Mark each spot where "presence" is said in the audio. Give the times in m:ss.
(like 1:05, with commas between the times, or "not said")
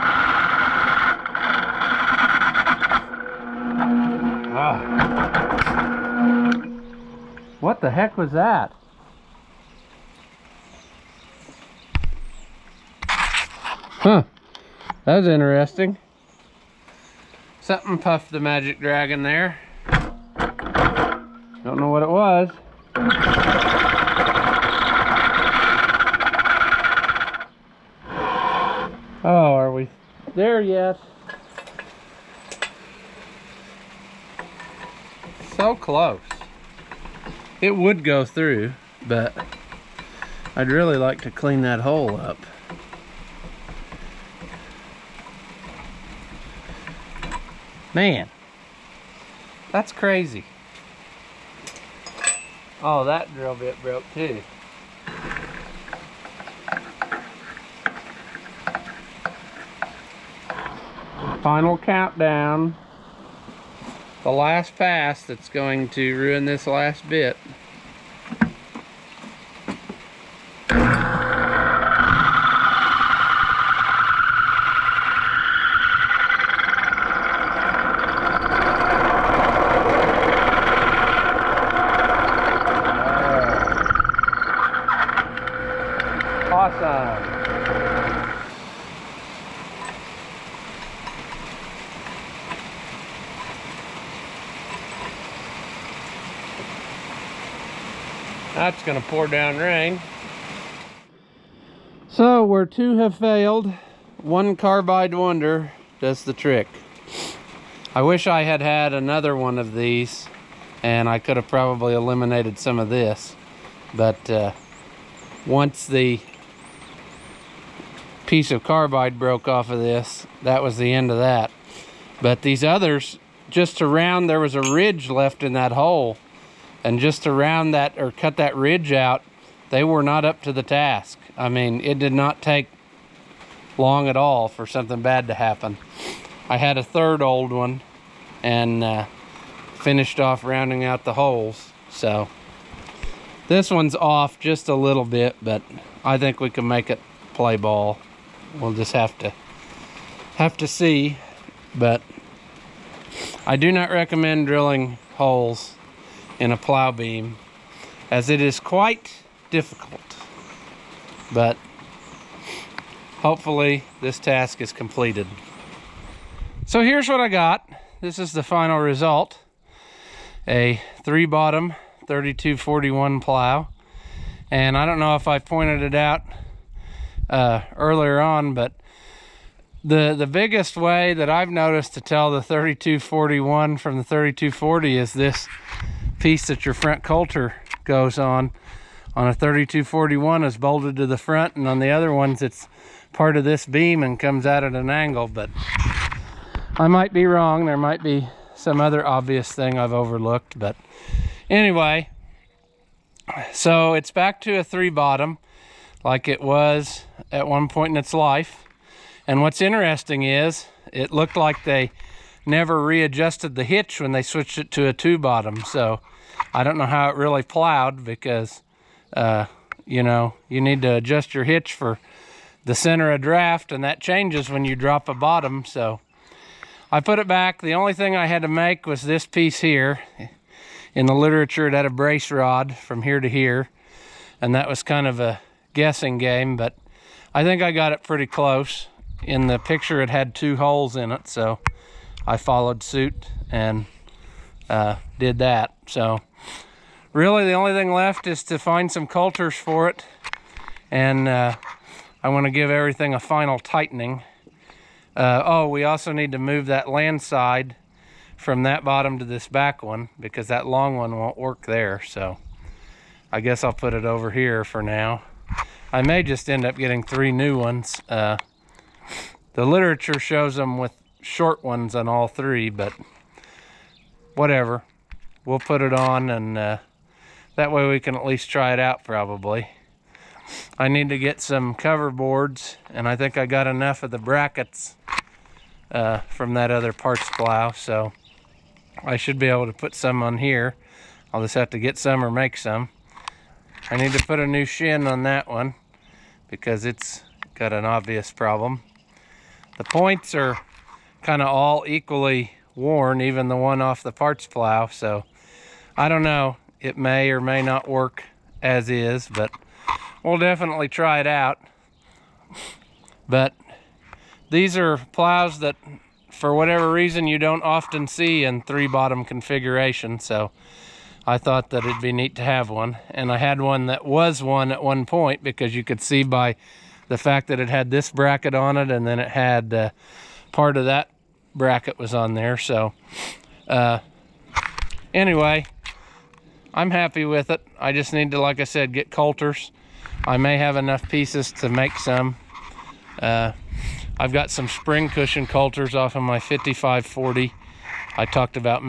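not said.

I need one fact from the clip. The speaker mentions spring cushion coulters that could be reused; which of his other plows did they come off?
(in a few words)
5540.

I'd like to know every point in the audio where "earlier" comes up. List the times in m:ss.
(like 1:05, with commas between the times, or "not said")
2:57.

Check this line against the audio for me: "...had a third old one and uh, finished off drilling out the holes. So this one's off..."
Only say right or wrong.
wrong.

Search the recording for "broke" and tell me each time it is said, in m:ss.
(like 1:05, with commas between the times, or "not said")
0:53, 1:59.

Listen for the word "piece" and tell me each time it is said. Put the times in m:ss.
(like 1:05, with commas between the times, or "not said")
1:58, 3:06, 3:49, 5:41.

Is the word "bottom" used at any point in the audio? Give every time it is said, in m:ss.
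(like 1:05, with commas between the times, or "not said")
2:51, 3:24, 3:35, 3:45, 4:18, 5:18.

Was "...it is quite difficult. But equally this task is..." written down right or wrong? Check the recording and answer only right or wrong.
wrong.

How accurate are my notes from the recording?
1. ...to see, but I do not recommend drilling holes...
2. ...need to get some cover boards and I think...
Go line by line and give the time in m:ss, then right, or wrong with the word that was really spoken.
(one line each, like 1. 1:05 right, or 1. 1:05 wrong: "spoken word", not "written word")
1. 2:30 right
2. 4:40 right.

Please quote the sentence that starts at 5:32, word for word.
So uh, anyway, I'm happy with it.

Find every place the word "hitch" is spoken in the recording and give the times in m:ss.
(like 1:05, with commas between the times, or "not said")
3:33, 3:41.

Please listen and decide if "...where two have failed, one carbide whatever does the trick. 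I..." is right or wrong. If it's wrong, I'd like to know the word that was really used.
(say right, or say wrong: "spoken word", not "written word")
wrong: "wonder", not "whatever".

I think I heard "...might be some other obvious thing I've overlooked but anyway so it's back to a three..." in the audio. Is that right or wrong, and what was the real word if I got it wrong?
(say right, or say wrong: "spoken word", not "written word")
right.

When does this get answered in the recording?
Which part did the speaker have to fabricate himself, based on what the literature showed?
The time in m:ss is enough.
3:51.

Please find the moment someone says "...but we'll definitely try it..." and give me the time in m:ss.
5:09.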